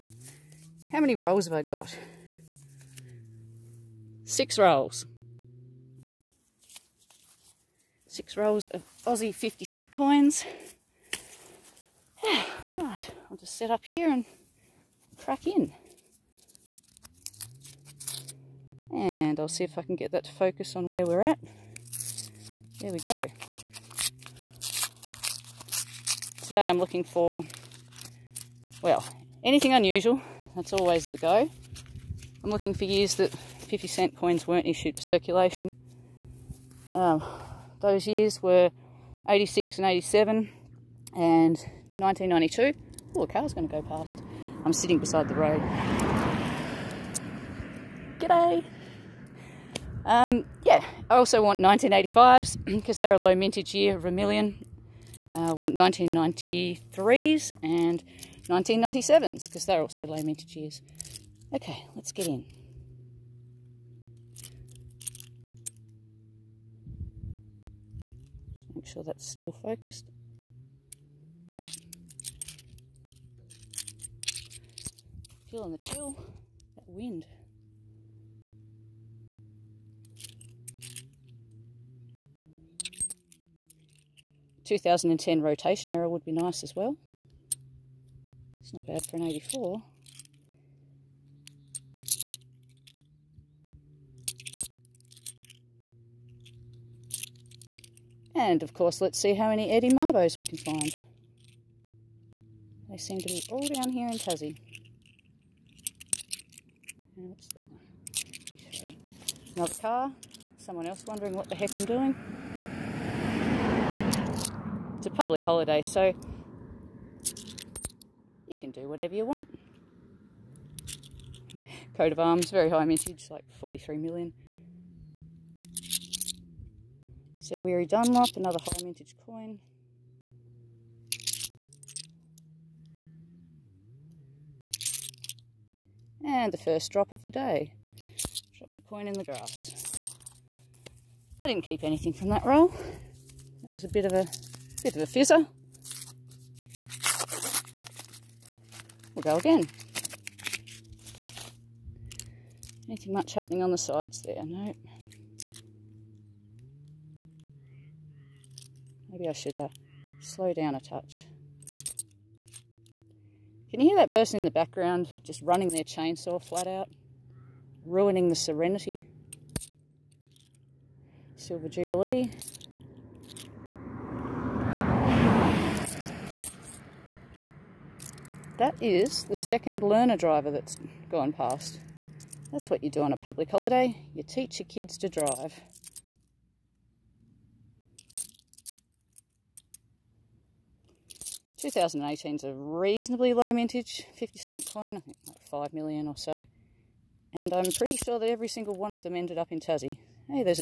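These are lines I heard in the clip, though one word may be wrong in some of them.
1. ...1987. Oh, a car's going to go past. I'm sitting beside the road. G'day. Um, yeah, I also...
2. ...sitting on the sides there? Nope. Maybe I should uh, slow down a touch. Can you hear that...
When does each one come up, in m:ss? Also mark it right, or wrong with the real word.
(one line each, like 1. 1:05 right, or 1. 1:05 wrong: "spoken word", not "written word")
1. 0:41 wrong: "1992", not "1987"
2. 2:33 wrong: "happening", not "sitting".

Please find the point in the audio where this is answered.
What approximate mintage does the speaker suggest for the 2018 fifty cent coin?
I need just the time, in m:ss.
3:15.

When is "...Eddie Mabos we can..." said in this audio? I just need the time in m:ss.
1:39.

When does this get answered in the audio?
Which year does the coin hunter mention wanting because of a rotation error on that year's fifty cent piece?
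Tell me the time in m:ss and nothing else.
1:24.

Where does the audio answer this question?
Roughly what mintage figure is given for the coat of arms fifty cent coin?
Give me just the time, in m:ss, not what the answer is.
2:03.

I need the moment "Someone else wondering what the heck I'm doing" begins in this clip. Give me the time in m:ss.
1:50.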